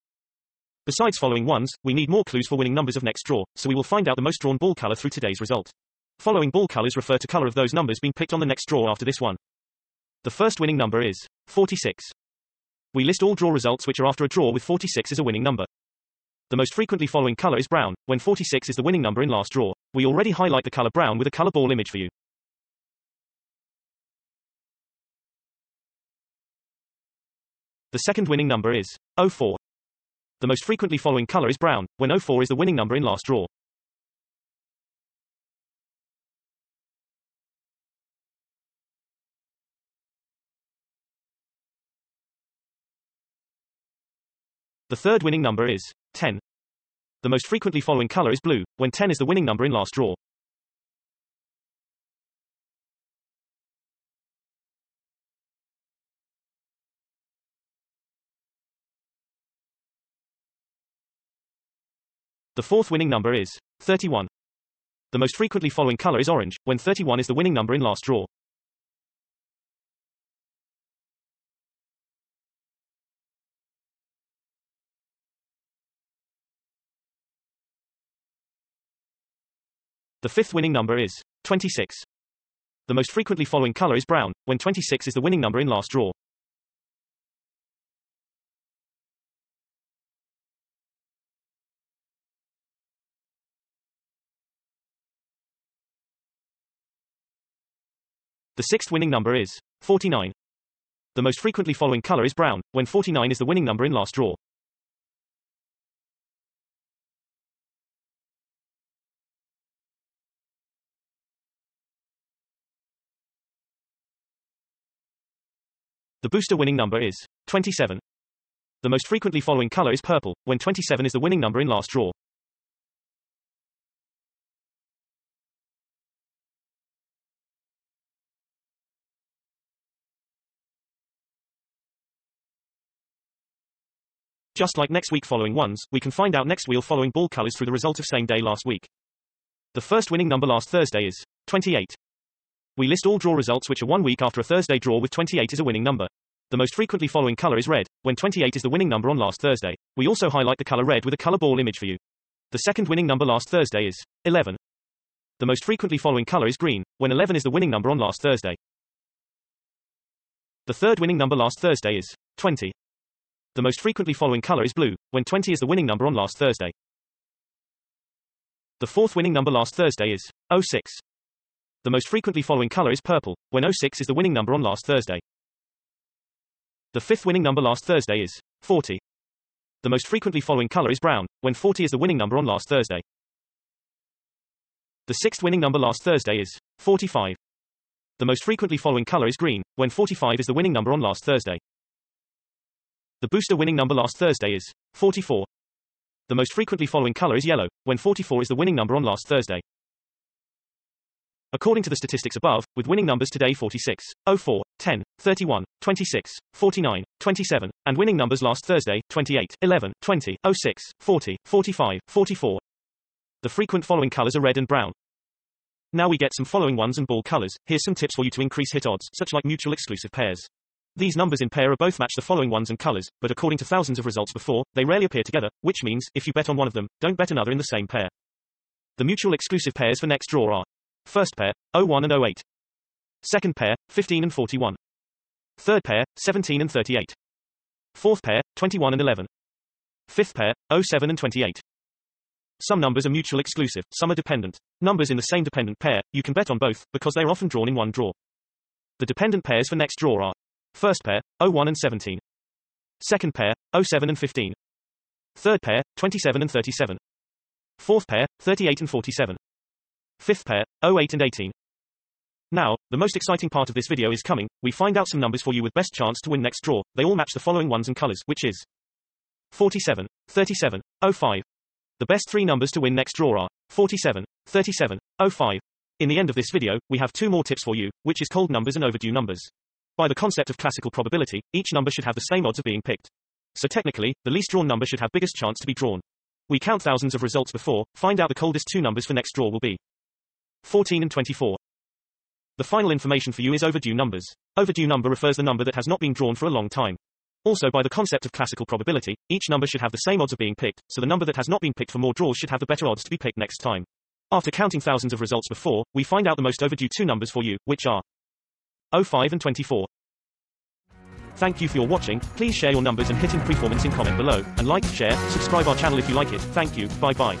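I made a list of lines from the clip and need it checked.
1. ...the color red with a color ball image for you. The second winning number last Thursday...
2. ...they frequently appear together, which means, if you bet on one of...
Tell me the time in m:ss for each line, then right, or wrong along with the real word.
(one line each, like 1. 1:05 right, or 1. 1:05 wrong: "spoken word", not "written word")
1. 2:30 right
2. 3:44 wrong: "rarely", not "frequently".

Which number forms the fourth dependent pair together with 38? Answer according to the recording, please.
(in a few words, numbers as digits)
47.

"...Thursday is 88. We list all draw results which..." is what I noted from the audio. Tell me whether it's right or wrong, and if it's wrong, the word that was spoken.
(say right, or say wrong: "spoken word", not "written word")
wrong: "28", not "88".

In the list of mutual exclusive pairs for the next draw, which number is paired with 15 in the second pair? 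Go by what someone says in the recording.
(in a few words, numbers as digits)
41.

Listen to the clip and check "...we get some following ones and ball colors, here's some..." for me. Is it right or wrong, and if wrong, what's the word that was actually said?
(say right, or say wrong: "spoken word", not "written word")
right.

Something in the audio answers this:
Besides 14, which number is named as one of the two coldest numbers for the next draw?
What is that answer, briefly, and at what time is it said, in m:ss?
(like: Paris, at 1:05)
24, at 4:50.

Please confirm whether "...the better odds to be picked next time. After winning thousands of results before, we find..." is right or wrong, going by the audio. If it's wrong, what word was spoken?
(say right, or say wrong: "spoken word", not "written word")
wrong: "counting", not "winning".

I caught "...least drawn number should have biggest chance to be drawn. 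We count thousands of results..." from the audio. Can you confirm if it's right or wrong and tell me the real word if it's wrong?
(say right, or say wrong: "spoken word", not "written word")
right.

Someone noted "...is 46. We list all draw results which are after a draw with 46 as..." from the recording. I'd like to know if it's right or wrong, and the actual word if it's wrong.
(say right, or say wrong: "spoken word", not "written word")
right.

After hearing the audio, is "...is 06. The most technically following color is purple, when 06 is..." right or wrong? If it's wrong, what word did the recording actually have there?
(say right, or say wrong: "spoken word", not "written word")
wrong: "frequently", not "technically".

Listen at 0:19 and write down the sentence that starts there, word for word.
We already highlight the color brown with a color ball image for you.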